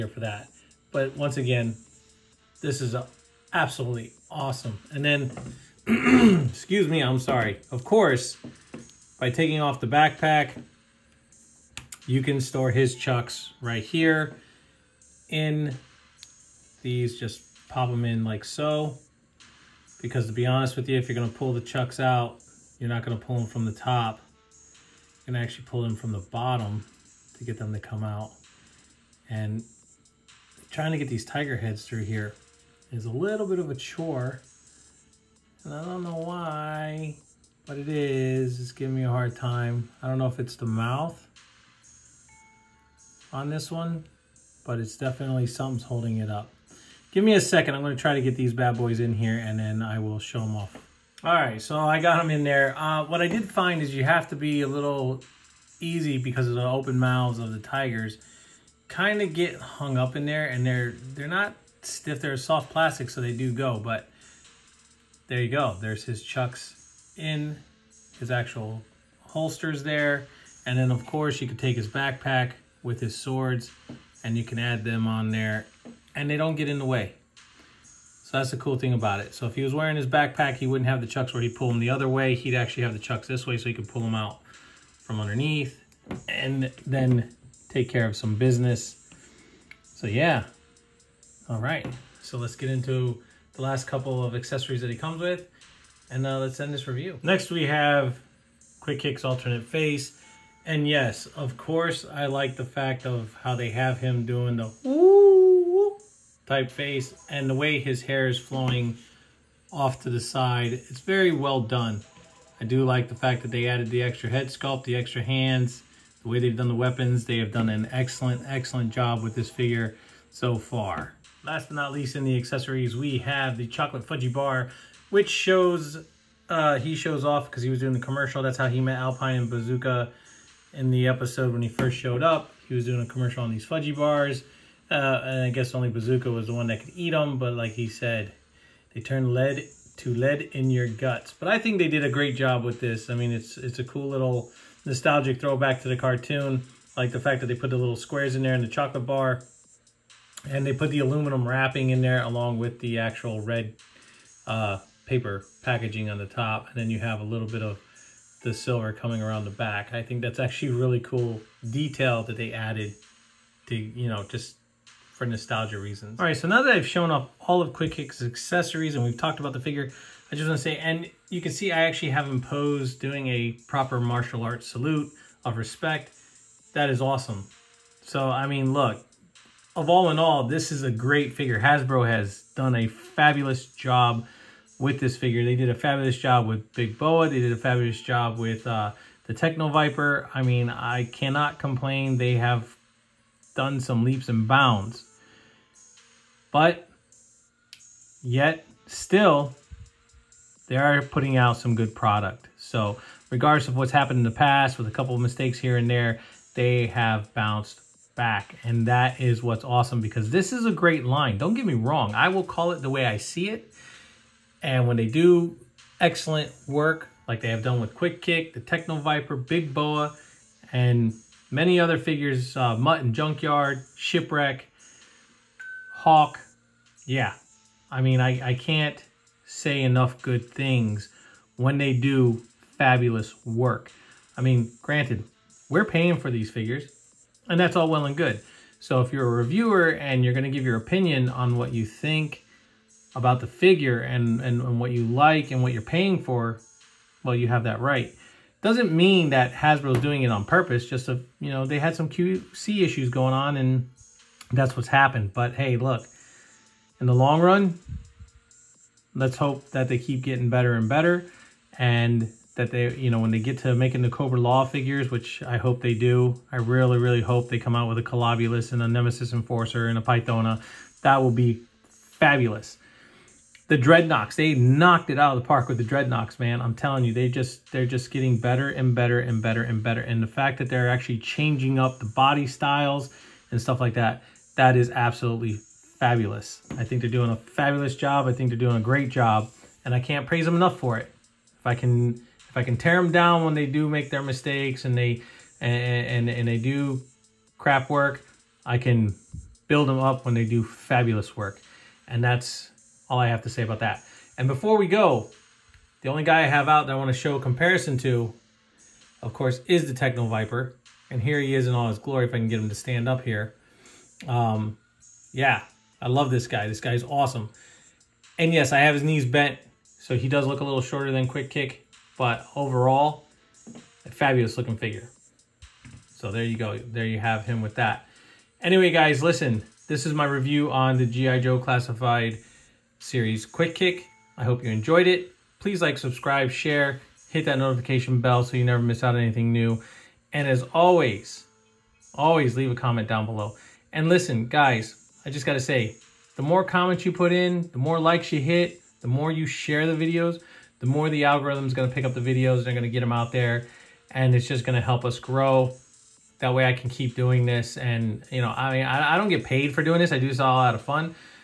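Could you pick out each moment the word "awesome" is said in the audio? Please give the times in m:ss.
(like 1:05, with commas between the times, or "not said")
0:04, 2:57, 3:29, 5:17.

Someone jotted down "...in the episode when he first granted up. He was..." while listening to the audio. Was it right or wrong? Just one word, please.
wrong.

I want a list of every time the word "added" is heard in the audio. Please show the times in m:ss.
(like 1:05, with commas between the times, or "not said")
1:53, 2:42.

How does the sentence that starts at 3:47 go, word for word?
Yeah, I mean, I, I can't say enough good things when they do fabulous work.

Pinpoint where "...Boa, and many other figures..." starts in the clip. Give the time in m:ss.
3:39.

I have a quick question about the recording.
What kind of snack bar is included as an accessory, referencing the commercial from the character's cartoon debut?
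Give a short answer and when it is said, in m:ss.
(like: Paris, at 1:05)
Chocolate fudgy bar, at 2:03.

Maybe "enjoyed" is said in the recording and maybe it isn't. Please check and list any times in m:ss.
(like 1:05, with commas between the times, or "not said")
5:34.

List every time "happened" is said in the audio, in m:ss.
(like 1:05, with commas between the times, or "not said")
3:23, 4:14.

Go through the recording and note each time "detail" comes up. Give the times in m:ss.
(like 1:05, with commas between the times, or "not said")
2:41.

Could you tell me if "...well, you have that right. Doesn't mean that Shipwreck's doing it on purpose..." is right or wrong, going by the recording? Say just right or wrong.
wrong.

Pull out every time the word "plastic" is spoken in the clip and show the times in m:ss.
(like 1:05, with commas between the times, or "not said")
1:02.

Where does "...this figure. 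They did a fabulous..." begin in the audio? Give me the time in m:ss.
3:04.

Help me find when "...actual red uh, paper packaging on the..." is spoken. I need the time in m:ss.
2:32.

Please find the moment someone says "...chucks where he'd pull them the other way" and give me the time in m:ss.
1:21.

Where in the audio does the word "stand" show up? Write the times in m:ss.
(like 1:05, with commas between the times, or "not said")
5:12.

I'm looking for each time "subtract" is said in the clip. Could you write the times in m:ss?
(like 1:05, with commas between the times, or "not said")
not said.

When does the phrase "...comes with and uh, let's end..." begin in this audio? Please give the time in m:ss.
1:34.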